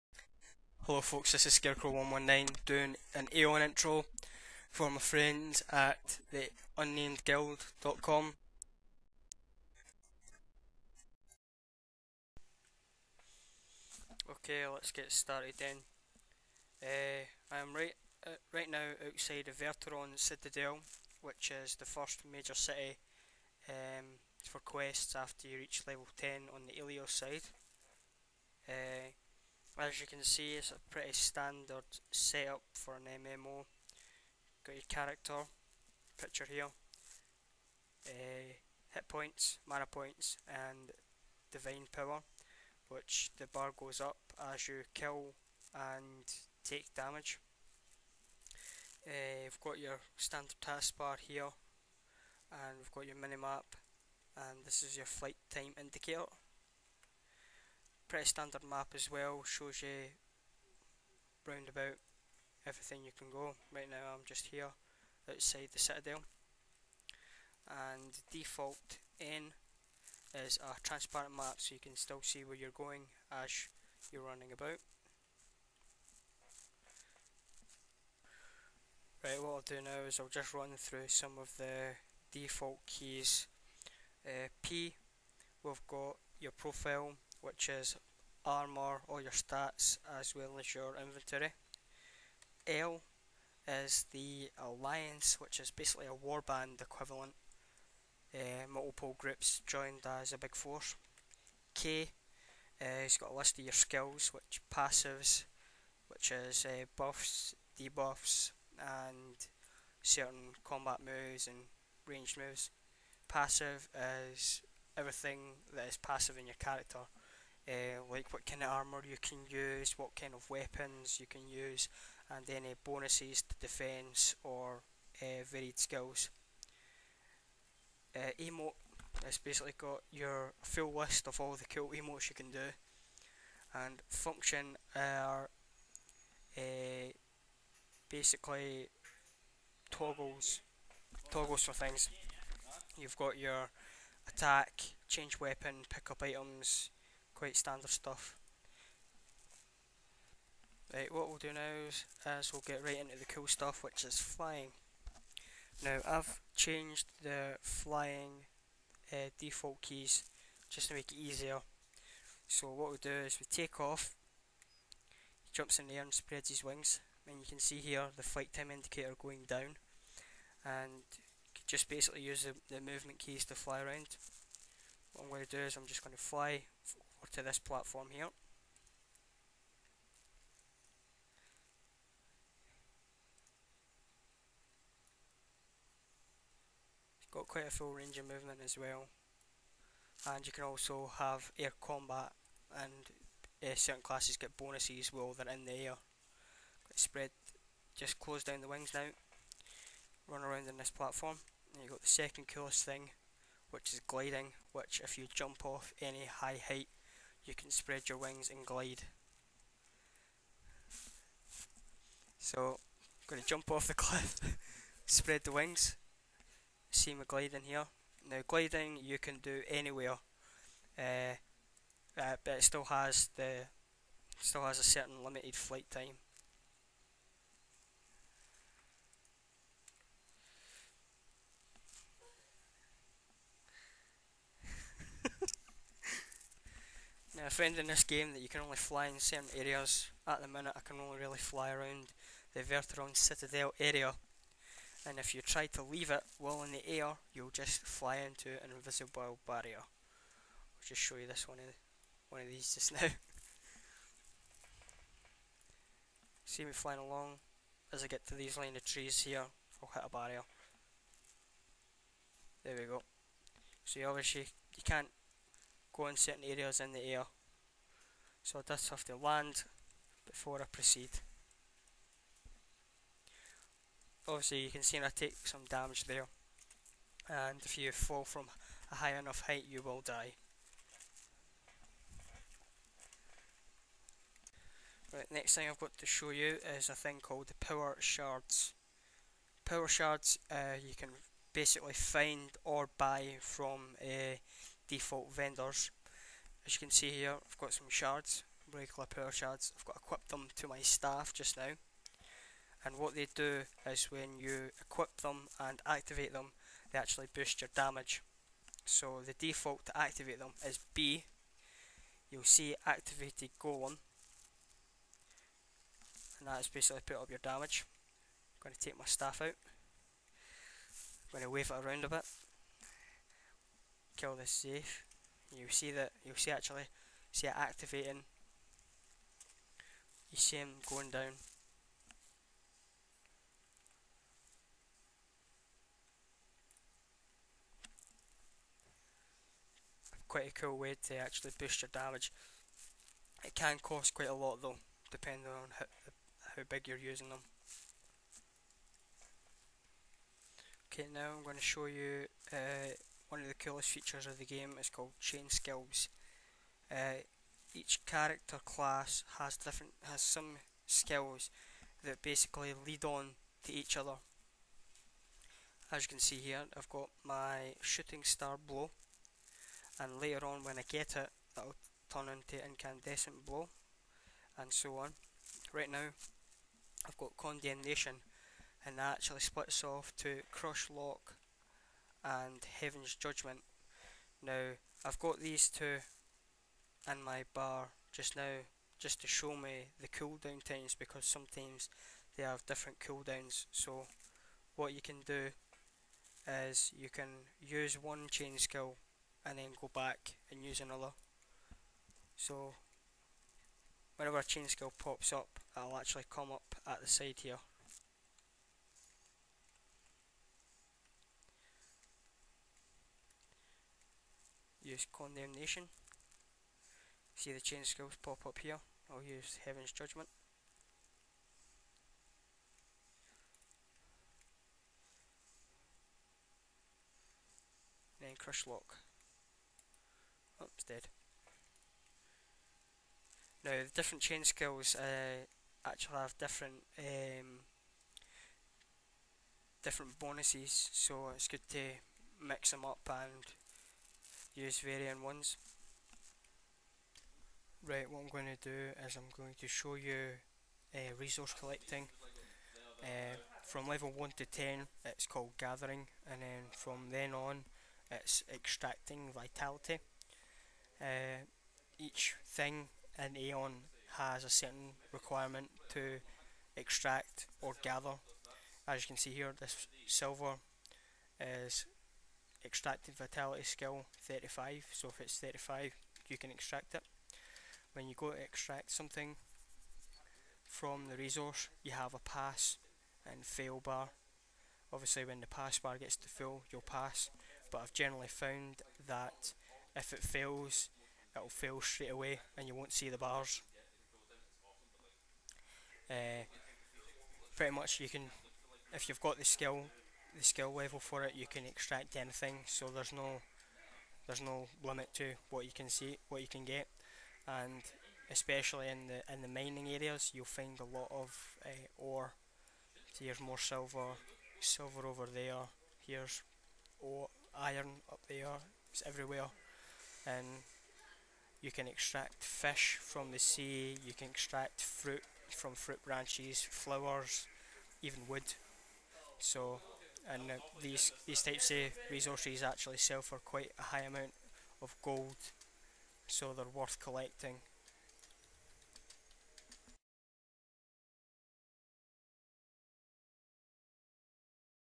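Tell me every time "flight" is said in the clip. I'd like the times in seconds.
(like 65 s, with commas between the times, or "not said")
55 s, 168 s, 225 s.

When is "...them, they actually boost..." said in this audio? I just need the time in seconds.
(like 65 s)
306 s.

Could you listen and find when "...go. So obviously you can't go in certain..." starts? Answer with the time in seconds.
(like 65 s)
262 s.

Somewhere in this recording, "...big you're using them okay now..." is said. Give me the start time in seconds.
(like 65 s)
346 s.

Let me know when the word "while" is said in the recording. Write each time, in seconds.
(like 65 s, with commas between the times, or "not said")
195 s, 246 s.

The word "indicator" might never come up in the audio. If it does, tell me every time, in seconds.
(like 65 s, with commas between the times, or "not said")
55 s, 168 s.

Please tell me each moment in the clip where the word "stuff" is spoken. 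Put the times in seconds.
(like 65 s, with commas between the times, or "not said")
147 s, 153 s.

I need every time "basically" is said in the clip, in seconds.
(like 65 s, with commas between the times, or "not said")
95 s, 129 s, 138 s, 171 s, 291 s, 316 s, 362 s.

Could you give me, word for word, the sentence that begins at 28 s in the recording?
Uh, as you can see, it's a pretty standard setup for an MMO.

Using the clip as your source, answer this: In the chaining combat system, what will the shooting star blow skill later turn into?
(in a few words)
Incandescent blow.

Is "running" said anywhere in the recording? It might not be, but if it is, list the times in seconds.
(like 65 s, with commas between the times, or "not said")
74 s.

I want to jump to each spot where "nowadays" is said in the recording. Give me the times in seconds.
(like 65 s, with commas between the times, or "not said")
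not said.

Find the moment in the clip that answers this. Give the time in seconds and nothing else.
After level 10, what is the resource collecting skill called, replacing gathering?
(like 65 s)
458 s.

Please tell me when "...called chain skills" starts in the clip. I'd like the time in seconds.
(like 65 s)
354 s.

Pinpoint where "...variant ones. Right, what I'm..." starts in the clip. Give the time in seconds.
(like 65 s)
444 s.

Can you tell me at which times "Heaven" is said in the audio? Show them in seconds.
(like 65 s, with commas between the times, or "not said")
382 s, 419 s.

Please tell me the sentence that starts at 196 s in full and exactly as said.
Spread, just close down the wings now.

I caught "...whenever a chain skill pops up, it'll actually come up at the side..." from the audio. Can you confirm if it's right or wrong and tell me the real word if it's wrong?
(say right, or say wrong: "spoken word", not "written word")
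right.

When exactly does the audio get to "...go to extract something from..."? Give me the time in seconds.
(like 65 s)
478 s.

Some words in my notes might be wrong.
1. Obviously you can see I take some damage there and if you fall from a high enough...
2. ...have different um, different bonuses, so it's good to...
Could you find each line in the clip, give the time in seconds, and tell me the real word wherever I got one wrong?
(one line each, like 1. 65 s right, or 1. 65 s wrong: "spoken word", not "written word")
1. 274 s right
2. 436 s right.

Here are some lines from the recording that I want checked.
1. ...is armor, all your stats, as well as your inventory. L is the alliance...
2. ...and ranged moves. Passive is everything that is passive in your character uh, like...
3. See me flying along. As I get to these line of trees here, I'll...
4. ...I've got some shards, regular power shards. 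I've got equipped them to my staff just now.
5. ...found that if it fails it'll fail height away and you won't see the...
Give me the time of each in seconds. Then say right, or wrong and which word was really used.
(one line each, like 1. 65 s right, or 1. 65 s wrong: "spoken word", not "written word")
1. 87 s right
2. 111 s right
3. 256 s right
4. 297 s right
5. 488 s wrong: "straight", not "height".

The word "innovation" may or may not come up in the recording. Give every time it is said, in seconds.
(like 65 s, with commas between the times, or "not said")
not said.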